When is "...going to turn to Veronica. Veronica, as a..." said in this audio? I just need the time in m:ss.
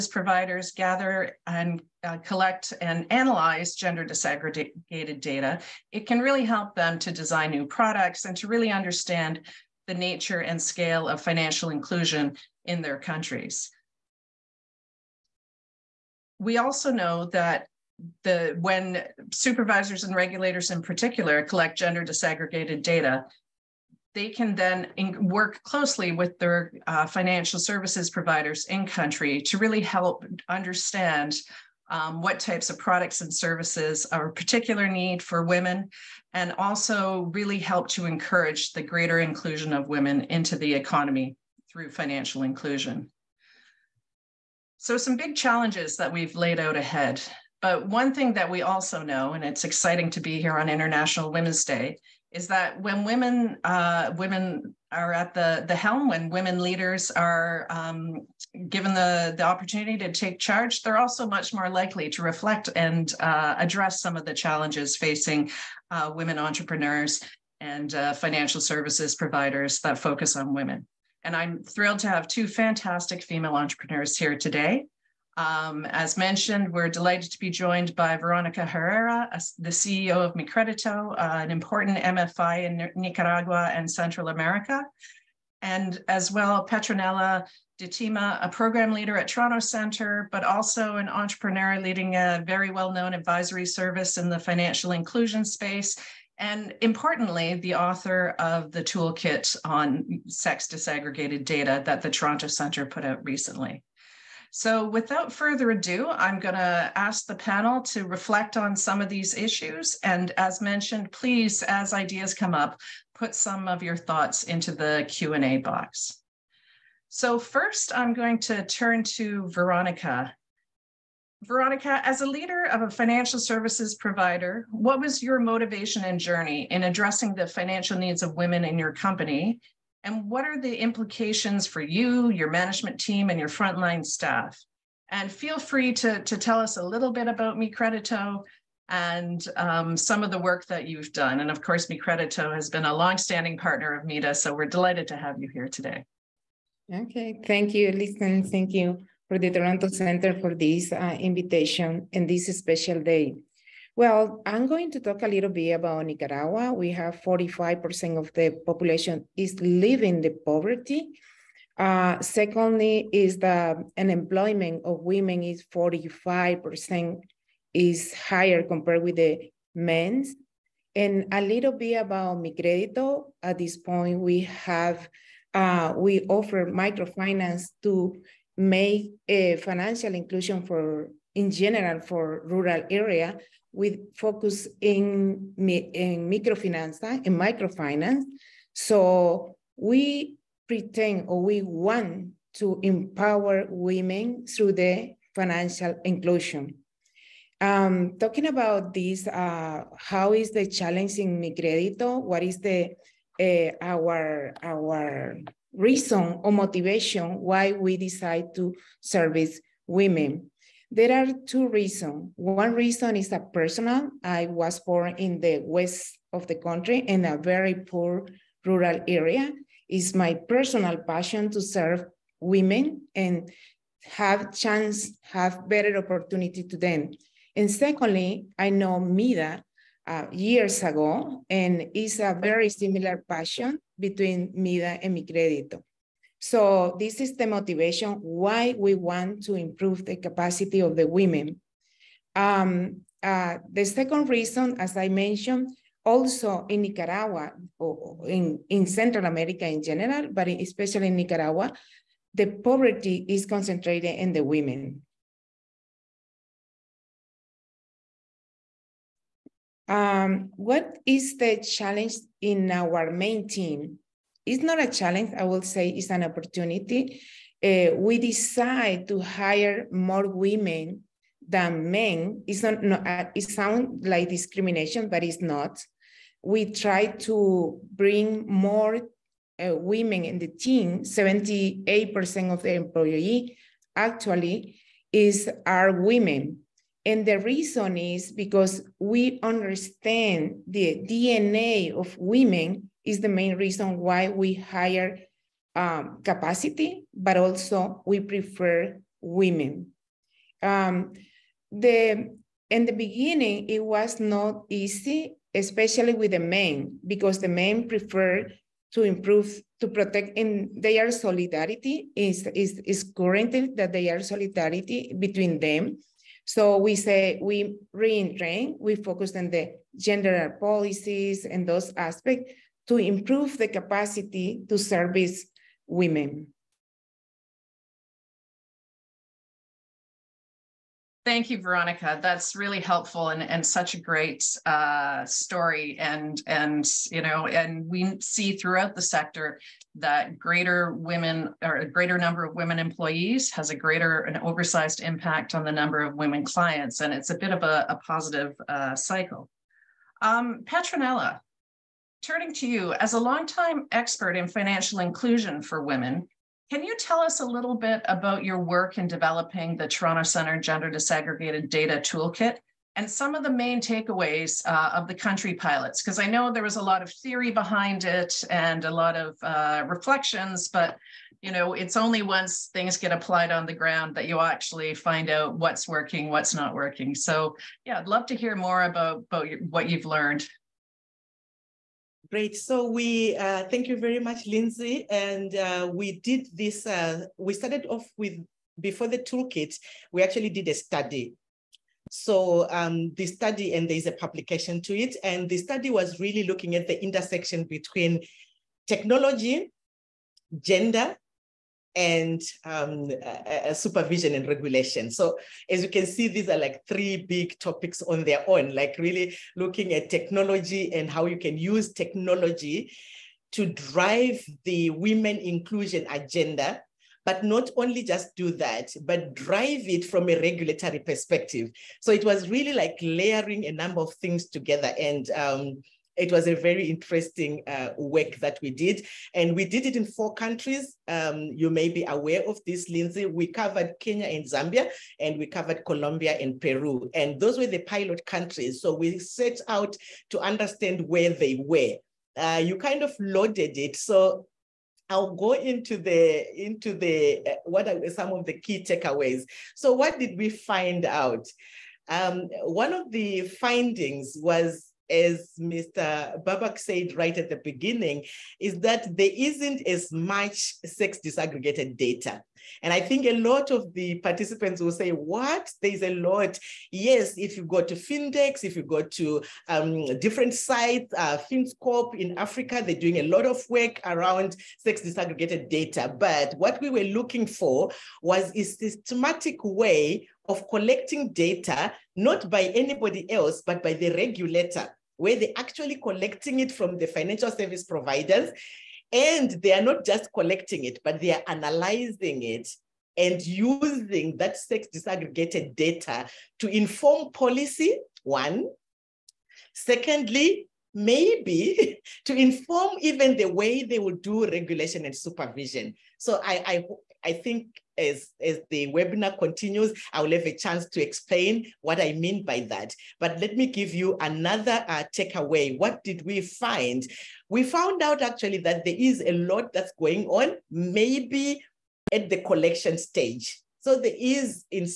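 1:58.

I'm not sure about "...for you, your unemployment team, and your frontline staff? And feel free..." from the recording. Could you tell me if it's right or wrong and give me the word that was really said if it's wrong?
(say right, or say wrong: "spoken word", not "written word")
wrong: "management", not "unemployment".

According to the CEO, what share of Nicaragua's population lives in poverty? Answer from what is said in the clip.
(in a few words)
45%.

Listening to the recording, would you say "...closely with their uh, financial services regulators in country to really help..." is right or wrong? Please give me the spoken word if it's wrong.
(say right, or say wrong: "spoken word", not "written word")
wrong: "providers", not "regulators".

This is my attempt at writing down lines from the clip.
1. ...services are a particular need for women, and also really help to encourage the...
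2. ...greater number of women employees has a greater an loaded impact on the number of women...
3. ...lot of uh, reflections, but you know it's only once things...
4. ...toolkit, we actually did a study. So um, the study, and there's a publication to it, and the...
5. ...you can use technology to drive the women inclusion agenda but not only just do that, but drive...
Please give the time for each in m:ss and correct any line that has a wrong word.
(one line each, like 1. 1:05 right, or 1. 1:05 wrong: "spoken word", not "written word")
1. 0:33 right
2. 5:41 wrong: "oversized", not "loaded"
3. 6:08 right
4. 6:29 right
5. 6:51 right.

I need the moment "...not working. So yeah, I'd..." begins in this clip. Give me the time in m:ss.
6:16.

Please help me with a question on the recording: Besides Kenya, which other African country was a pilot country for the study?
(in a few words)
Zambia.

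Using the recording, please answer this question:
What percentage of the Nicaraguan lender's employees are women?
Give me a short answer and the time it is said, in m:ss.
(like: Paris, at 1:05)
78%, at 4:41.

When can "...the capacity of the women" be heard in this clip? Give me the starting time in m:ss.
4:00.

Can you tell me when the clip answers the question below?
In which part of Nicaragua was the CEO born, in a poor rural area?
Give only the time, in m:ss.
3:35.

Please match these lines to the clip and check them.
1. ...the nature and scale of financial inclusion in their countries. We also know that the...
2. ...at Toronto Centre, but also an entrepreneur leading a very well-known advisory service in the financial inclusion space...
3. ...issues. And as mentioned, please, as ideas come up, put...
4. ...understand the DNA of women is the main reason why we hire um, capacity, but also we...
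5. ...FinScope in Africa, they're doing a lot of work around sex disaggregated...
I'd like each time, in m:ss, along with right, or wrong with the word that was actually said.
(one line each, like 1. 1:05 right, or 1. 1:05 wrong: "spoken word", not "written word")
1. 0:09 right
2. 1:29 right
3. 1:49 right
4. 4:49 right
5. 7:51 right.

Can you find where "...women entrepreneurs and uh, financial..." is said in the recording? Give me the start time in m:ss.
1:06.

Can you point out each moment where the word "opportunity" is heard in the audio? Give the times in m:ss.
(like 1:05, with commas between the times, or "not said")
0:59, 3:45, 4:26.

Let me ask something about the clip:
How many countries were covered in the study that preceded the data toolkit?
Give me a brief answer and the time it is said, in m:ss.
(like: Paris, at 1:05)
4, at 7:10.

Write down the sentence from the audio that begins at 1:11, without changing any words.
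And I'm thrilled to have two fantastic female entrepreneurs here today.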